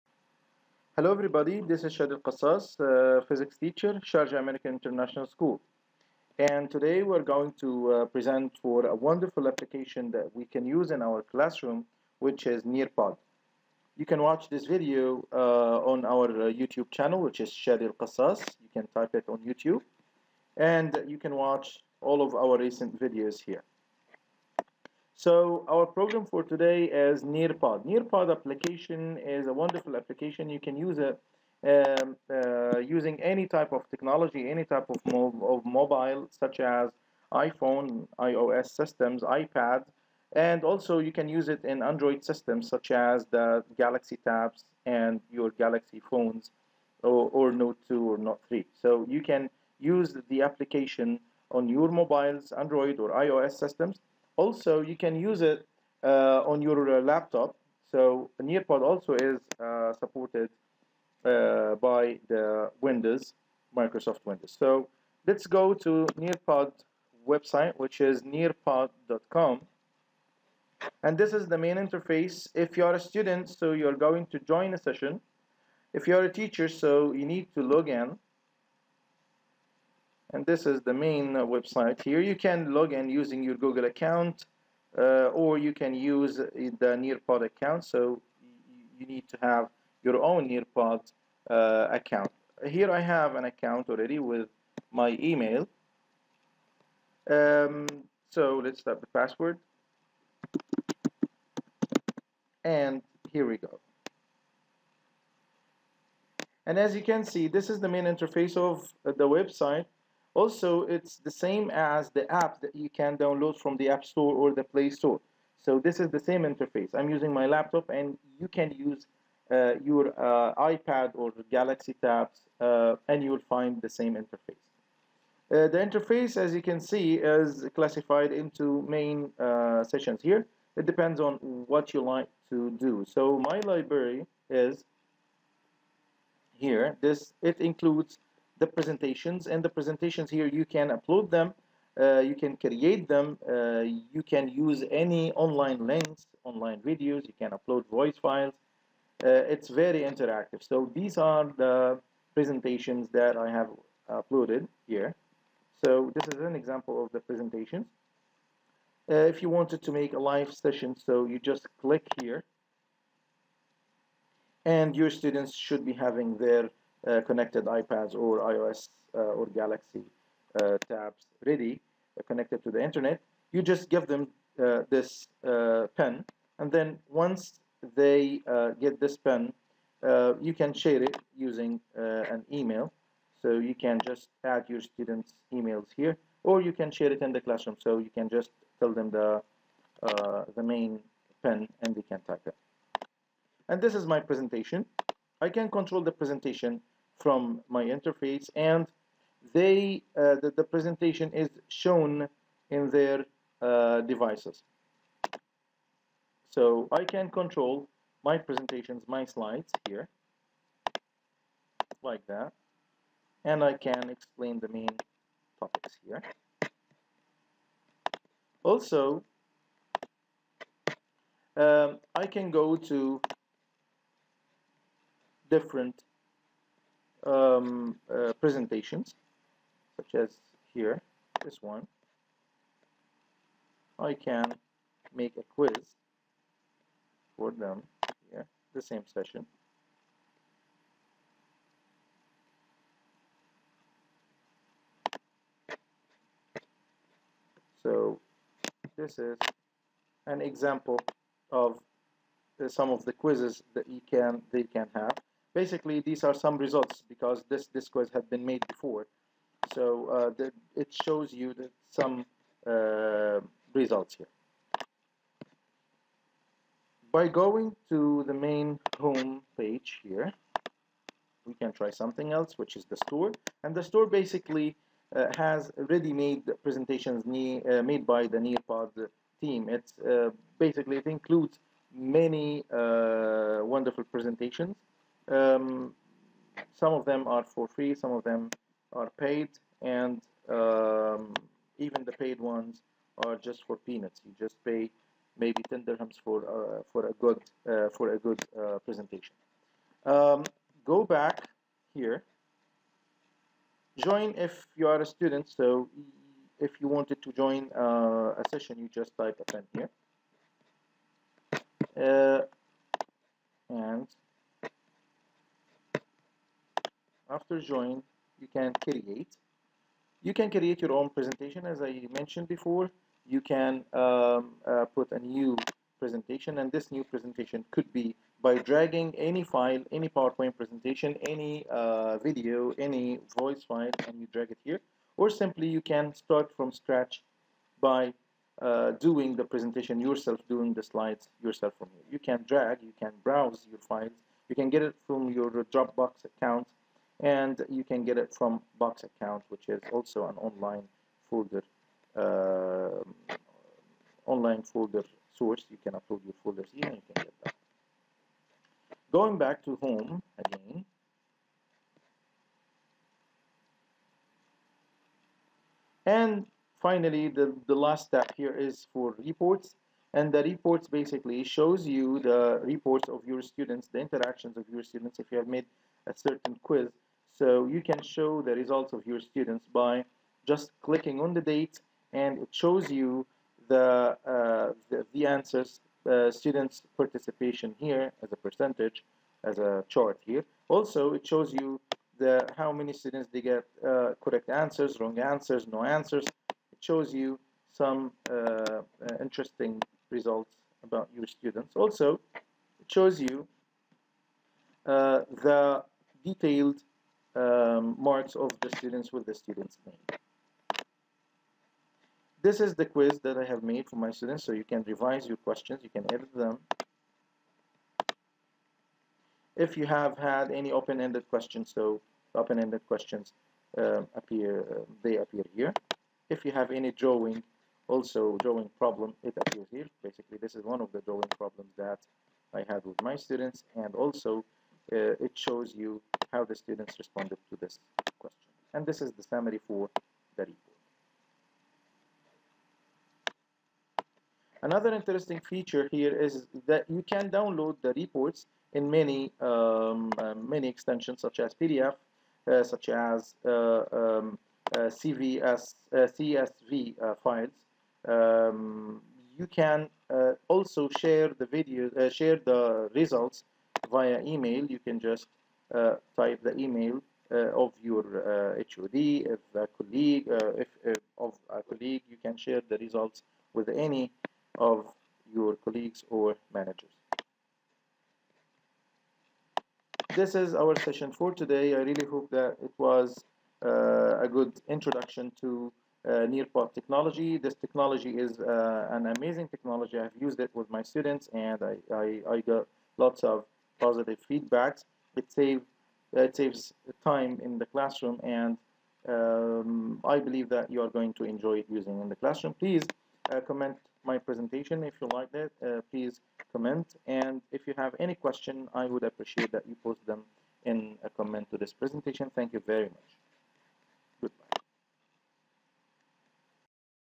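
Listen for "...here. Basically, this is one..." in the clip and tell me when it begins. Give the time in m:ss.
7:09.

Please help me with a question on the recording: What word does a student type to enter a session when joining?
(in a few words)
attend.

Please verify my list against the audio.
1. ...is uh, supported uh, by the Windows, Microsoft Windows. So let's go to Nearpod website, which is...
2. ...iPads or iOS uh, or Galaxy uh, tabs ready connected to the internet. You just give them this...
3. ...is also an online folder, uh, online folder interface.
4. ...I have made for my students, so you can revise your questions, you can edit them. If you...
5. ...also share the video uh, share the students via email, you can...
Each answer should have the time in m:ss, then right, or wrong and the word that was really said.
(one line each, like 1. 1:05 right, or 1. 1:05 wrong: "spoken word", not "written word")
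1. 0:59 right
2. 2:47 right
3. 5:49 wrong: "source", not "interface"
4. 6:53 right
5. 7:40 wrong: "results", not "students".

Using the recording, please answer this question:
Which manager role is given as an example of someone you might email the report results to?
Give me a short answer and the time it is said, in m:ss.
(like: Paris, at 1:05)
HOD, at 7:48.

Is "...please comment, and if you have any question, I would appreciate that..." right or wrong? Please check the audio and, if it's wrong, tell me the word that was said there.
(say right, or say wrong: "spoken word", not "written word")
right.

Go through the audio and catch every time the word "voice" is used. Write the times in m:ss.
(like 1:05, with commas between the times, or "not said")
2:27, 5:33.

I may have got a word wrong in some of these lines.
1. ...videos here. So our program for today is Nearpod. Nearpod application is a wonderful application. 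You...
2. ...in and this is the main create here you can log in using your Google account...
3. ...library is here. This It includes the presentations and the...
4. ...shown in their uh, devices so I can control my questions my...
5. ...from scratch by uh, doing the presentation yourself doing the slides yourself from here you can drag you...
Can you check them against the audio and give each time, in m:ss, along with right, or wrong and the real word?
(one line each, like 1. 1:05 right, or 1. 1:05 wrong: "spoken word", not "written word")
1. 0:23 right
2. 1:17 wrong: "website", not "create"
3. 2:13 right
4. 3:21 wrong: "presentations", not "questions"
5. 5:36 right.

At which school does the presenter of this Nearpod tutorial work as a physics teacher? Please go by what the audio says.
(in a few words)
Sharjah American International School.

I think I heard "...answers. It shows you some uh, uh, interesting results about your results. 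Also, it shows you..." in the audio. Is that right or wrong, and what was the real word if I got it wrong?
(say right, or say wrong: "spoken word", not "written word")
wrong: "students", not "results".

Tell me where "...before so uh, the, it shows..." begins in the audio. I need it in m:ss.
4:18.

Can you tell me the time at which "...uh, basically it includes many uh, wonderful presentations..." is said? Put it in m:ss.
4:39.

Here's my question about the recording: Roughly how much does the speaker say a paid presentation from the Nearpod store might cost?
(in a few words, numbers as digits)
10 dirhams.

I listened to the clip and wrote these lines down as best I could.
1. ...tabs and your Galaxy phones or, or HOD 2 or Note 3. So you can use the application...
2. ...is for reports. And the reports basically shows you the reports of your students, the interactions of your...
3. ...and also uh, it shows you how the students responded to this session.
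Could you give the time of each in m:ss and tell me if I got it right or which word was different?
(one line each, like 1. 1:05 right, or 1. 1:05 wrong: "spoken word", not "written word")
1. 0:44 wrong: "Note", not "HOD"
2. 6:08 right
3. 7:13 wrong: "question", not "session".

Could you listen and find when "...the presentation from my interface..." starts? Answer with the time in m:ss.
3:16.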